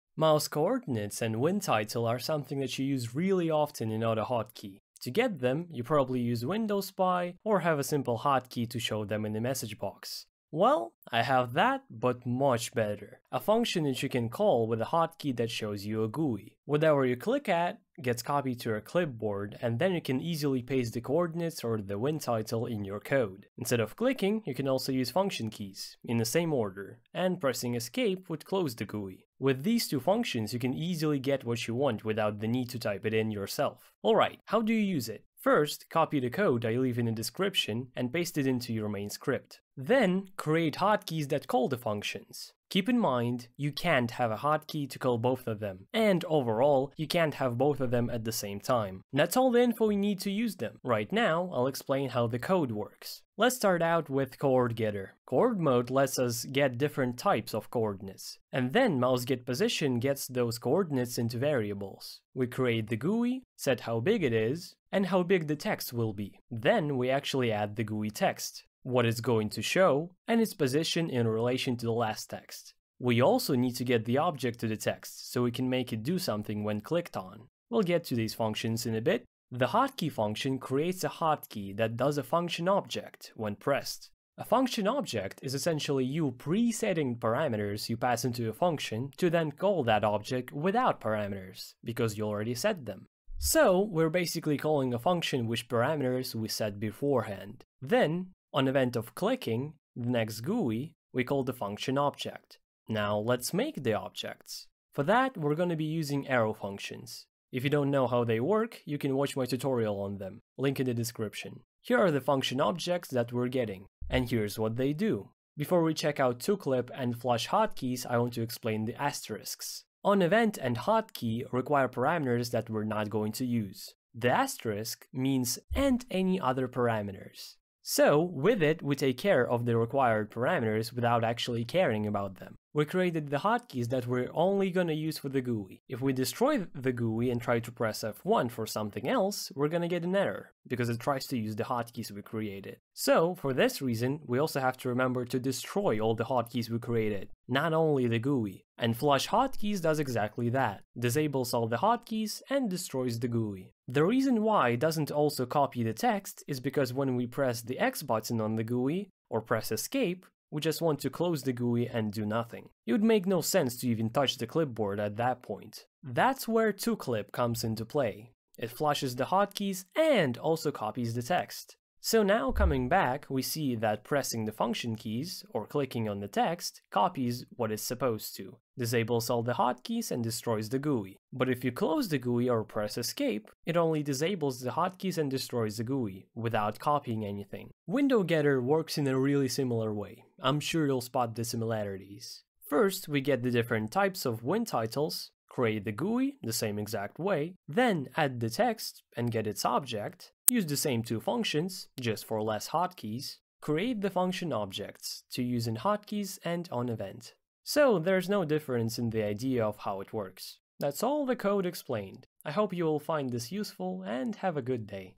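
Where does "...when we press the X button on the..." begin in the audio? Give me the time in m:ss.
2:36.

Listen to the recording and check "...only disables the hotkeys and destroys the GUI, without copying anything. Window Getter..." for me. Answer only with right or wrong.
right.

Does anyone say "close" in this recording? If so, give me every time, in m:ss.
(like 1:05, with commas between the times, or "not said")
0:28, 2:41, 3:01.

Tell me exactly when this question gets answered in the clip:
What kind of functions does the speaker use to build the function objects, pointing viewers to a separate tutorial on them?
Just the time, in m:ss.
1:46.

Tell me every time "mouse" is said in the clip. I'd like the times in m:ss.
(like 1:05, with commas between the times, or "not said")
0:00, 0:59.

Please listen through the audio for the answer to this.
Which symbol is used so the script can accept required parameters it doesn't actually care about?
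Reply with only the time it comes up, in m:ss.
2:04.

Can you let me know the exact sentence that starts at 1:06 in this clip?
Then we actually add the GUI text what it's going to show, and its position in relation to the last text.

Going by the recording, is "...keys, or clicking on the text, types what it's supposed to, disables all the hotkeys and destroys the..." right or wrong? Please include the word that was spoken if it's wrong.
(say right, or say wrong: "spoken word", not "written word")
wrong: "copies", not "types".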